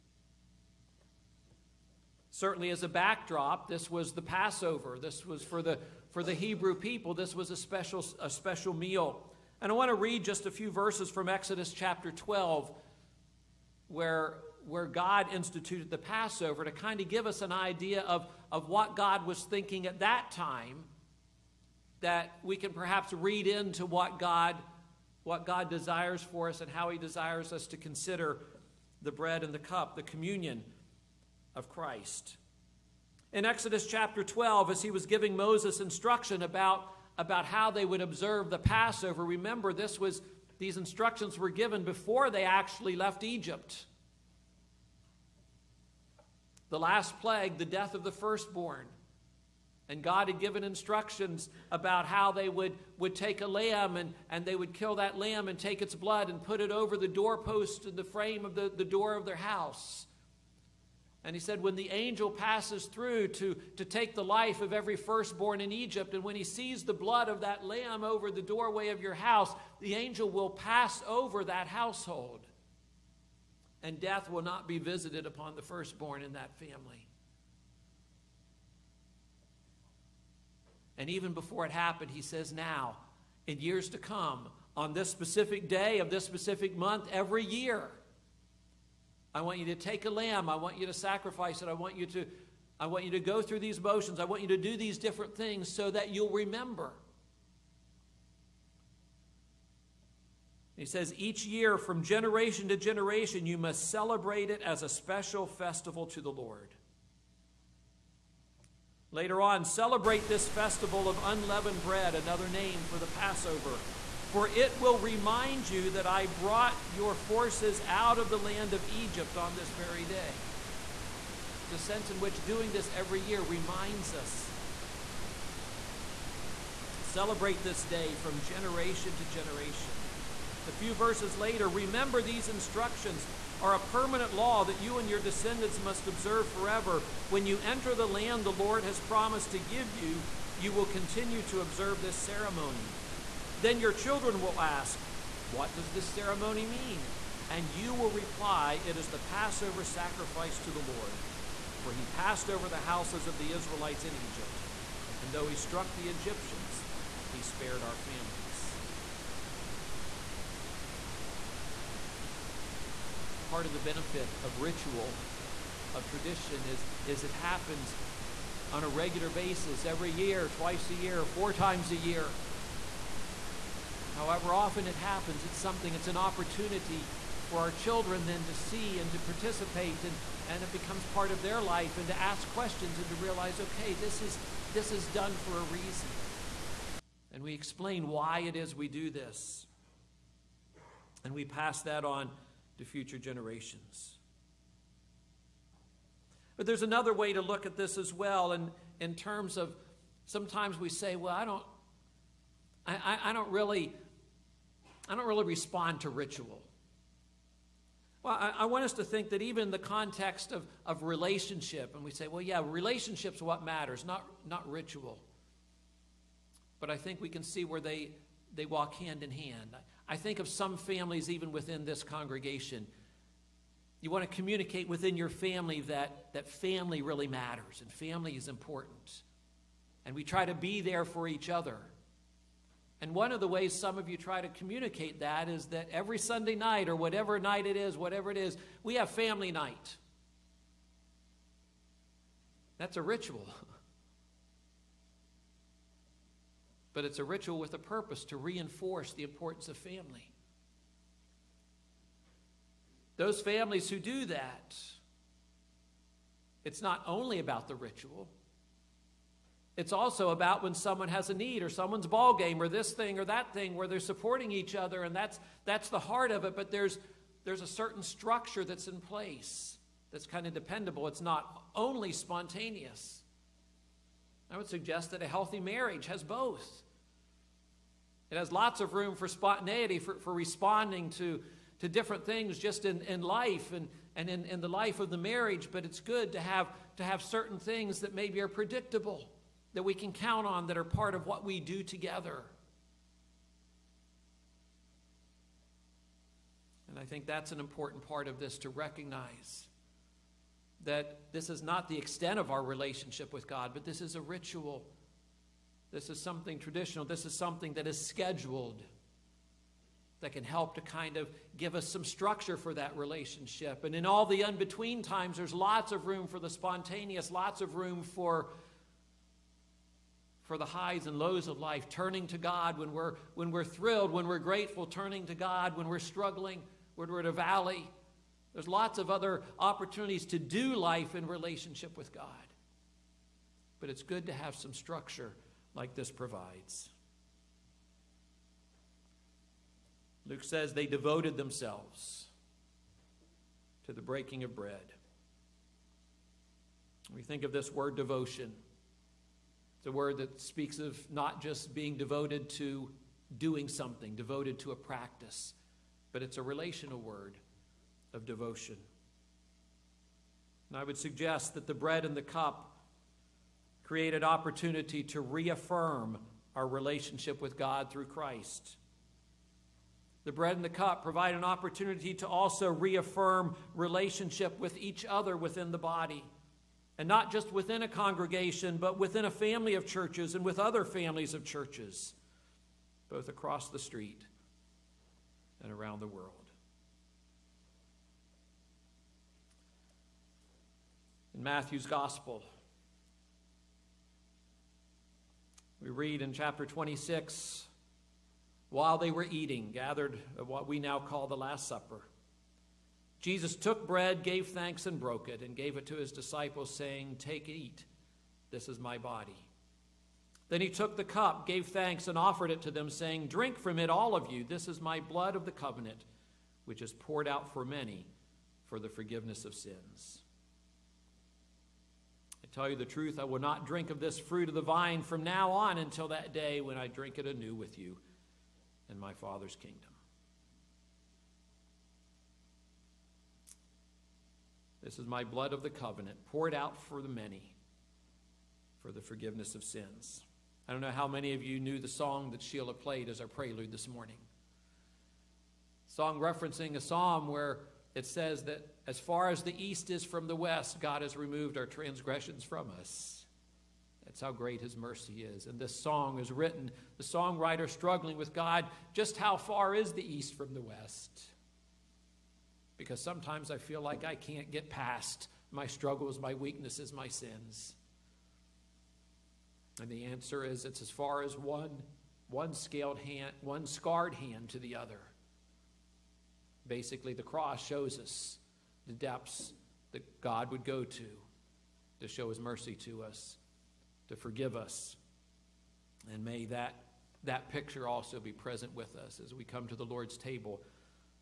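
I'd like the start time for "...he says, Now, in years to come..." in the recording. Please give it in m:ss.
1:22.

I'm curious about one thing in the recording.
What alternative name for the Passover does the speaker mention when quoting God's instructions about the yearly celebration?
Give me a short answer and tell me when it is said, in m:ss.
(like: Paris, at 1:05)
Festival of unleavened bread, at 1:50.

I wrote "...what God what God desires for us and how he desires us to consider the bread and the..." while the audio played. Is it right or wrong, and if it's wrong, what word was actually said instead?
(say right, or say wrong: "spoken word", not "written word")
right.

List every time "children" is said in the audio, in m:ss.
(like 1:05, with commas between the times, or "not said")
2:23, 2:57.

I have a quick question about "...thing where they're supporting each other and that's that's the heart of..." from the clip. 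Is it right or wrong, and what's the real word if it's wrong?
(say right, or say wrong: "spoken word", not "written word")
right.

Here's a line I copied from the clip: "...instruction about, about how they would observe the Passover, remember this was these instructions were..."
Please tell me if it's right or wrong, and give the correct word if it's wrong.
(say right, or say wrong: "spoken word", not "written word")
right.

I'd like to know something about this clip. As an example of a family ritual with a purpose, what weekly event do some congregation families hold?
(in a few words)
Family night.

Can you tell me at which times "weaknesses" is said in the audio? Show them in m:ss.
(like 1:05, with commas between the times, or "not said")
7:46.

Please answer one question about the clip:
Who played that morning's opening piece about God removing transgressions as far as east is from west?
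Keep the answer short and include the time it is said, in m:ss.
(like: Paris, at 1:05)
Sheila, at 7:22.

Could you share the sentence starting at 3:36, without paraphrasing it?
But I think we can see where they they walk hand in hand.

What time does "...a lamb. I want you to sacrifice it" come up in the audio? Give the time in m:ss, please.
1:30.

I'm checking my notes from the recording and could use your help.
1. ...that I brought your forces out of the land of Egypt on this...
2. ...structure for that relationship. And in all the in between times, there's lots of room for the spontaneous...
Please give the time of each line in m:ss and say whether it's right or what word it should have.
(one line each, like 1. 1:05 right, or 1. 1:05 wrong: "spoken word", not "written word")
1. 1:55 right
2. 5:12 right.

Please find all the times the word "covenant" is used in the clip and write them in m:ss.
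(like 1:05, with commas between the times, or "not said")
6:55, 7:15.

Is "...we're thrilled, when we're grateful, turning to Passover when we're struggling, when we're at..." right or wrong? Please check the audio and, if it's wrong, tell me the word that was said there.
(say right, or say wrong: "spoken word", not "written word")
wrong: "God", not "Passover".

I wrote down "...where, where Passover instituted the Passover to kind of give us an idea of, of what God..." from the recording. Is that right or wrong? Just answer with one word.
wrong.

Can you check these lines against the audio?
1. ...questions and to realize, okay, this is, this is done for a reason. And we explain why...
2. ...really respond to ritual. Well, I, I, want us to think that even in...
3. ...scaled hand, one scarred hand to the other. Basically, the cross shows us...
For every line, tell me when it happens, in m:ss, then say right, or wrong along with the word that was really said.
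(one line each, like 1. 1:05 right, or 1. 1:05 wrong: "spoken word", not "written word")
1. 3:02 right
2. 3:25 right
3. 7:52 right.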